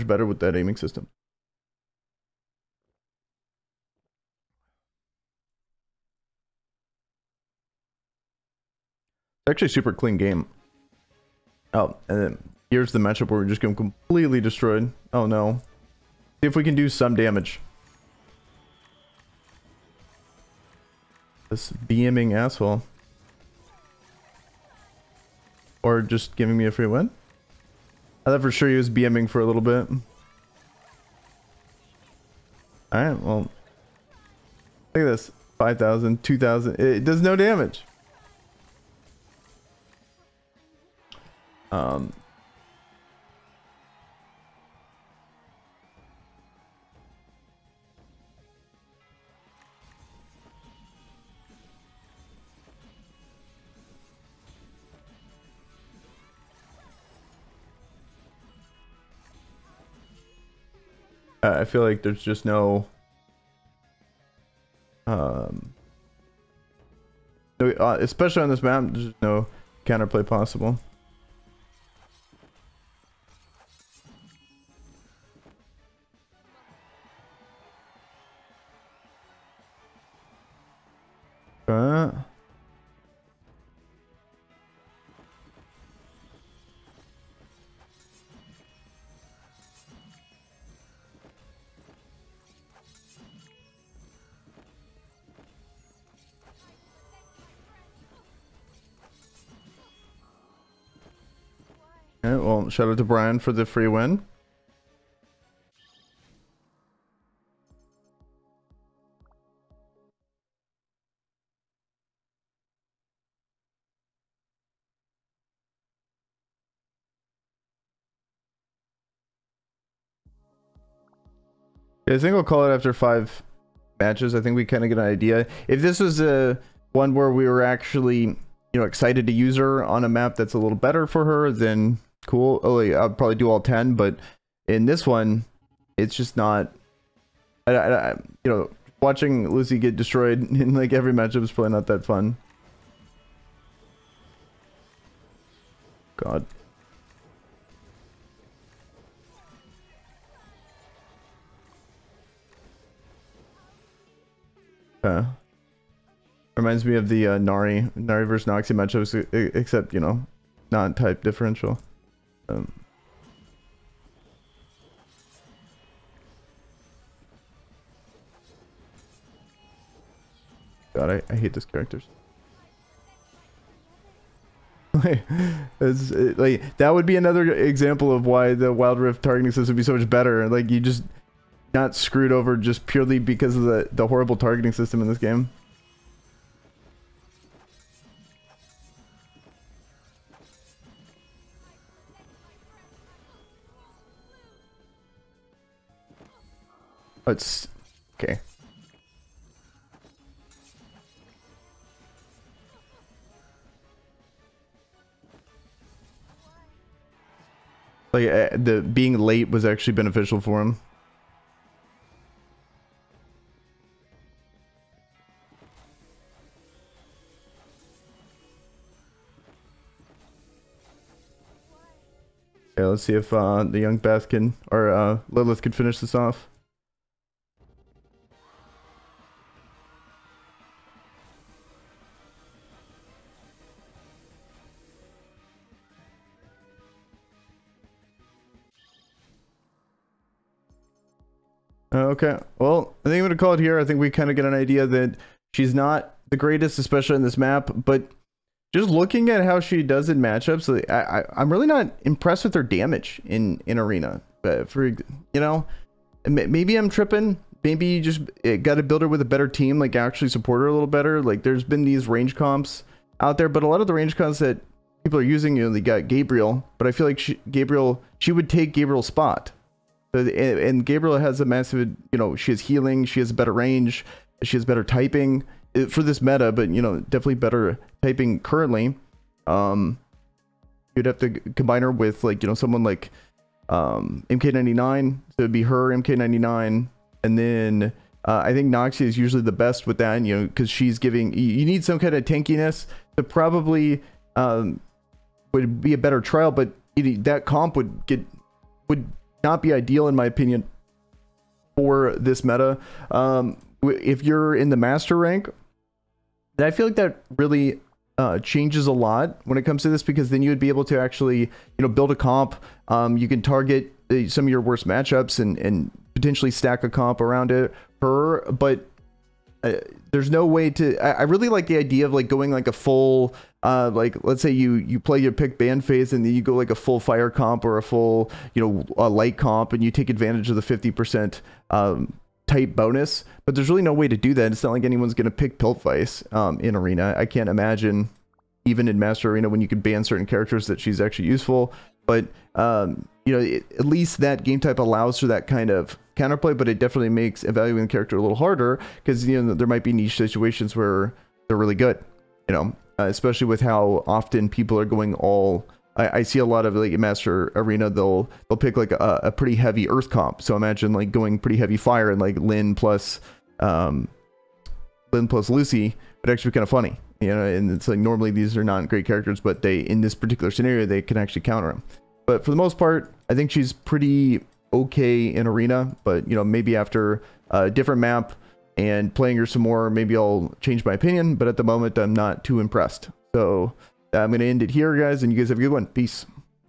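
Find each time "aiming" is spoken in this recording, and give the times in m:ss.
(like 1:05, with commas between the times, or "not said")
0:00.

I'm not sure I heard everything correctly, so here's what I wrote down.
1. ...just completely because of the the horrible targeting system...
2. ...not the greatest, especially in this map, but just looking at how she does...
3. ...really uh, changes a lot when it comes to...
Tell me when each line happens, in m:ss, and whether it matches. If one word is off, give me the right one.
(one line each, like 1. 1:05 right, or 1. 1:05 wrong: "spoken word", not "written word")
1. 3:02 wrong: "purely", not "completely"
2. 4:05 right
3. 5:07 right.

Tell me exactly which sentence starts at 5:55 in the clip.
I, I, see a lot of like Master Arena, they'll they'll pick like a, a, pretty heavy Earth comp.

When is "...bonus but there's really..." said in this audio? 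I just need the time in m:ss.
5:32.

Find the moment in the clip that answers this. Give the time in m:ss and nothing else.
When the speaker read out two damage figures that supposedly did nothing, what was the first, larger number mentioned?
0:35.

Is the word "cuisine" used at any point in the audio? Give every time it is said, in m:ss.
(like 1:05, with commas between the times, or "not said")
not said.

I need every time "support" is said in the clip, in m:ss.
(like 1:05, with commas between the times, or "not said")
4:20.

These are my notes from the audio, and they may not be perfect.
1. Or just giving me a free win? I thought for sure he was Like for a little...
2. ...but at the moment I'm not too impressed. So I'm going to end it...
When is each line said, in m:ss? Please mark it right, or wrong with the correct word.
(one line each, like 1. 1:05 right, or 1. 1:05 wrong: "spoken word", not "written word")
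1. 0:25 wrong: "BMing", not "Like"
2. 6:21 right.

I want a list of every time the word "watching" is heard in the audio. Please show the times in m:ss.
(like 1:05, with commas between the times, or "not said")
2:19.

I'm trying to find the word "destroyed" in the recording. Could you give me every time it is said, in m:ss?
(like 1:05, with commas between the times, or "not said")
0:14, 2:19.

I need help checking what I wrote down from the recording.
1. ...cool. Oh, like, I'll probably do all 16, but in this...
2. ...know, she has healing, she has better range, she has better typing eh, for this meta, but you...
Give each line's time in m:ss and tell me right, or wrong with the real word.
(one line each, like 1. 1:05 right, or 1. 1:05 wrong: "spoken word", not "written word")
1. 2:12 wrong: "10", not "16"
2. 4:32 right.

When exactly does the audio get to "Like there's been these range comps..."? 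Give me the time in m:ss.
4:21.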